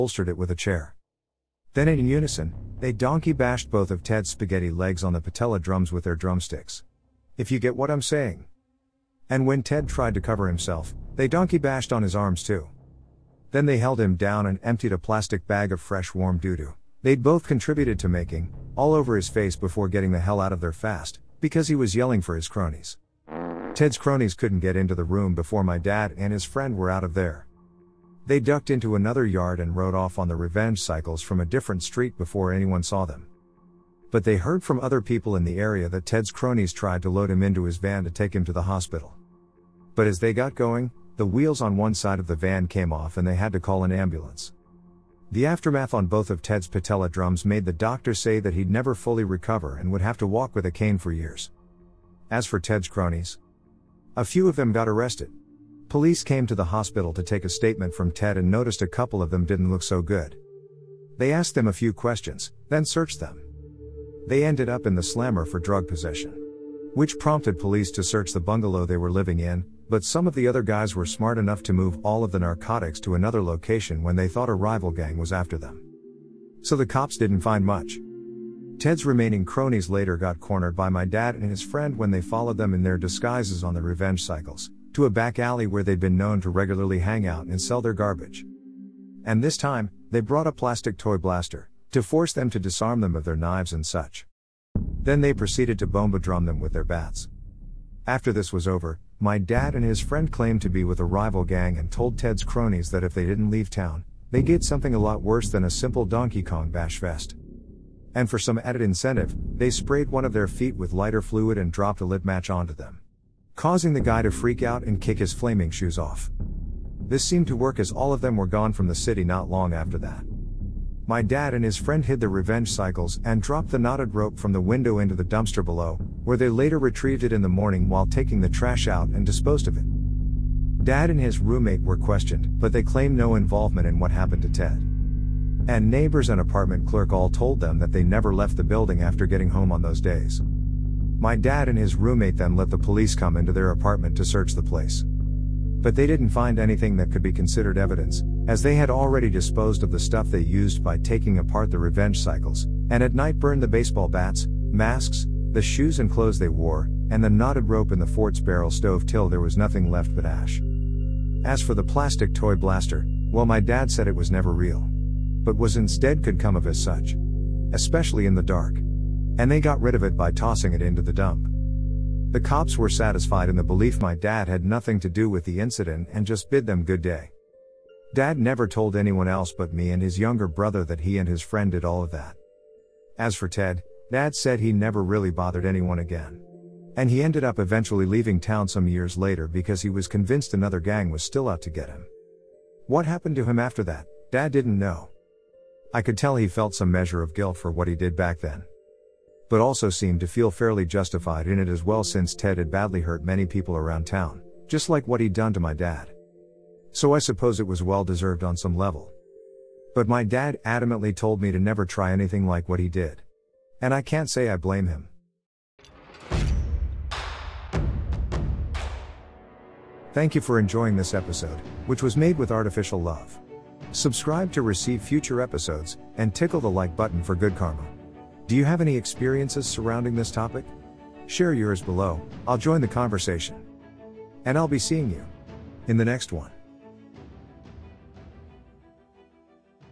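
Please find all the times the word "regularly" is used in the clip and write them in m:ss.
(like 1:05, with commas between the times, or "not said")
1:26.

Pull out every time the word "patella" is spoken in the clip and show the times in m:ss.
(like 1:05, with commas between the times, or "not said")
0:05, 0:46.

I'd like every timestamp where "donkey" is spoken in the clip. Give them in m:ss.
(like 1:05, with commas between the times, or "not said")
0:02, 0:11, 1:46.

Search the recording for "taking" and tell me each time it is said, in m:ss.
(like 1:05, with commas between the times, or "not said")
2:08, 2:30.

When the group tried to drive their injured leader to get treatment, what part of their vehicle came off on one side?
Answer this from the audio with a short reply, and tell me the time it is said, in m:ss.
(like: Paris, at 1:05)
The wheels, at 0:41.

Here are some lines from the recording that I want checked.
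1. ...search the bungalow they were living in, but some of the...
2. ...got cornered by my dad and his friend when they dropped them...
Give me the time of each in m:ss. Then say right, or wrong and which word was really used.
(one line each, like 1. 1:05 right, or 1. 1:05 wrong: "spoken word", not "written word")
1. 1:08 right
2. 1:20 wrong: "followed", not "dropped".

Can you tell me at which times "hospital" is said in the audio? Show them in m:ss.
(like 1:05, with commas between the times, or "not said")
0:38, 0:56.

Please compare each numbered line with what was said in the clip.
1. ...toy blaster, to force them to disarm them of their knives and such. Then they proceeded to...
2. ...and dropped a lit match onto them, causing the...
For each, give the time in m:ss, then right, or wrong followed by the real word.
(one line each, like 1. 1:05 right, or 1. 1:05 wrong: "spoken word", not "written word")
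1. 1:30 right
2. 1:51 right.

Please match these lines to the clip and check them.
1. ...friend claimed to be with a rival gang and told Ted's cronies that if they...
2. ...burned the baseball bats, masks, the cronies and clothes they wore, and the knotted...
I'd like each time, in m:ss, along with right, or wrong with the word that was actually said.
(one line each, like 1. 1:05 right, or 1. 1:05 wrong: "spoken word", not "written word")
1. 1:40 right
2. 2:33 wrong: "shoes", not "cronies".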